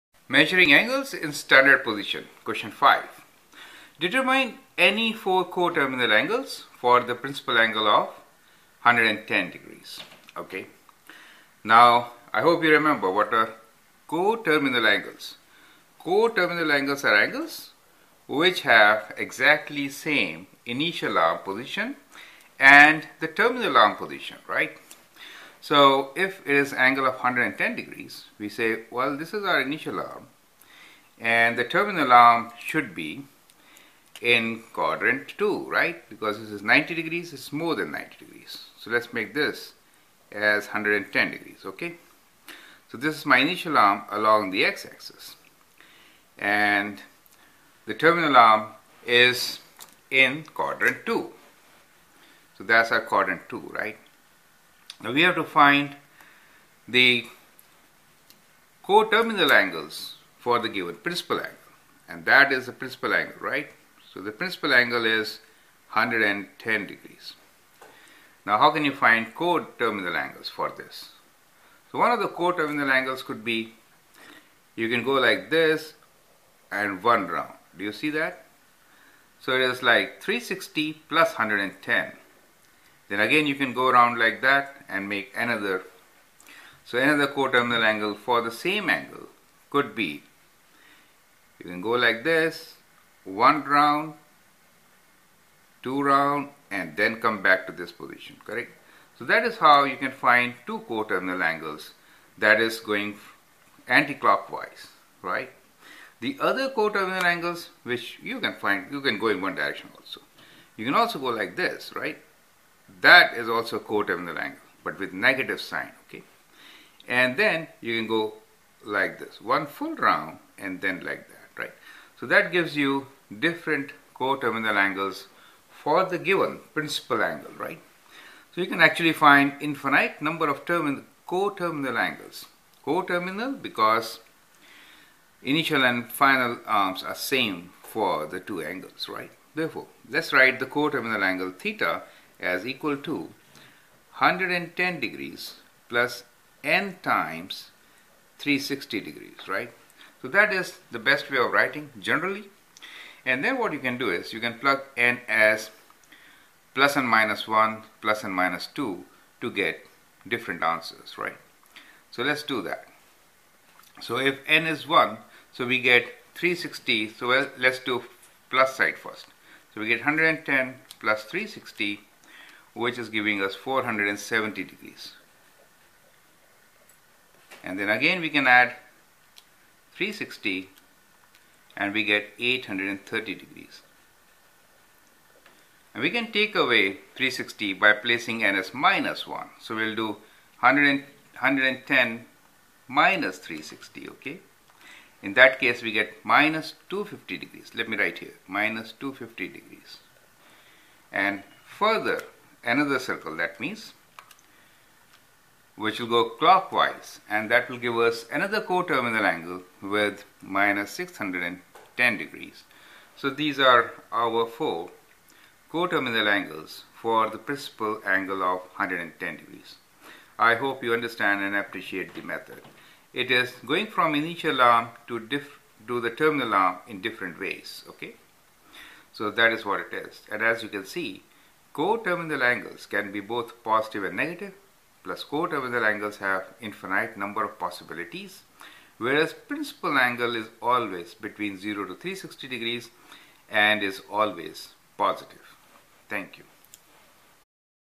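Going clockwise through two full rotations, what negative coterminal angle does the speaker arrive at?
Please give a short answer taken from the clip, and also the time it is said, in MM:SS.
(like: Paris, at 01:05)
-610 degrees, at 03:30.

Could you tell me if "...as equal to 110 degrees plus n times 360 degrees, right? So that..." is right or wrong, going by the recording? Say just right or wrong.
right.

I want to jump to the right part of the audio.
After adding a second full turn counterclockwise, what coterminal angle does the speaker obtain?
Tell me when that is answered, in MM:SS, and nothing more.
03:02.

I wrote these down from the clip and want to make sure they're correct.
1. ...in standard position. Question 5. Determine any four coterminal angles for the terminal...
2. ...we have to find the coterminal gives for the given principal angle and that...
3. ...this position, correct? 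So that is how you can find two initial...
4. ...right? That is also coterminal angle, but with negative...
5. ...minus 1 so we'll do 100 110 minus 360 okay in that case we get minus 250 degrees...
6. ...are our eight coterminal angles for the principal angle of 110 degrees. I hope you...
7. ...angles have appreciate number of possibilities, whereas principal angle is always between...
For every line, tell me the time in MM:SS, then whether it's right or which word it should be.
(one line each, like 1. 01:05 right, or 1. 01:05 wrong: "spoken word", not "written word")
1. 00:01 wrong: "principal", not "terminal"
2. 00:55 wrong: "angles", not "gives"
3. 01:37 wrong: "coterminal", not "initial"
4. 01:51 right
5. 03:08 right
6. 03:33 wrong: "four", not "eight"
7. 03:55 wrong: "infinite", not "appreciate".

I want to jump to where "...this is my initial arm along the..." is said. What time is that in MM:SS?
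00:42.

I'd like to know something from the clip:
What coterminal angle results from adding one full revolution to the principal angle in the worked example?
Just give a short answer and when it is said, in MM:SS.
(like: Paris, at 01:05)
470 degrees, at 02:53.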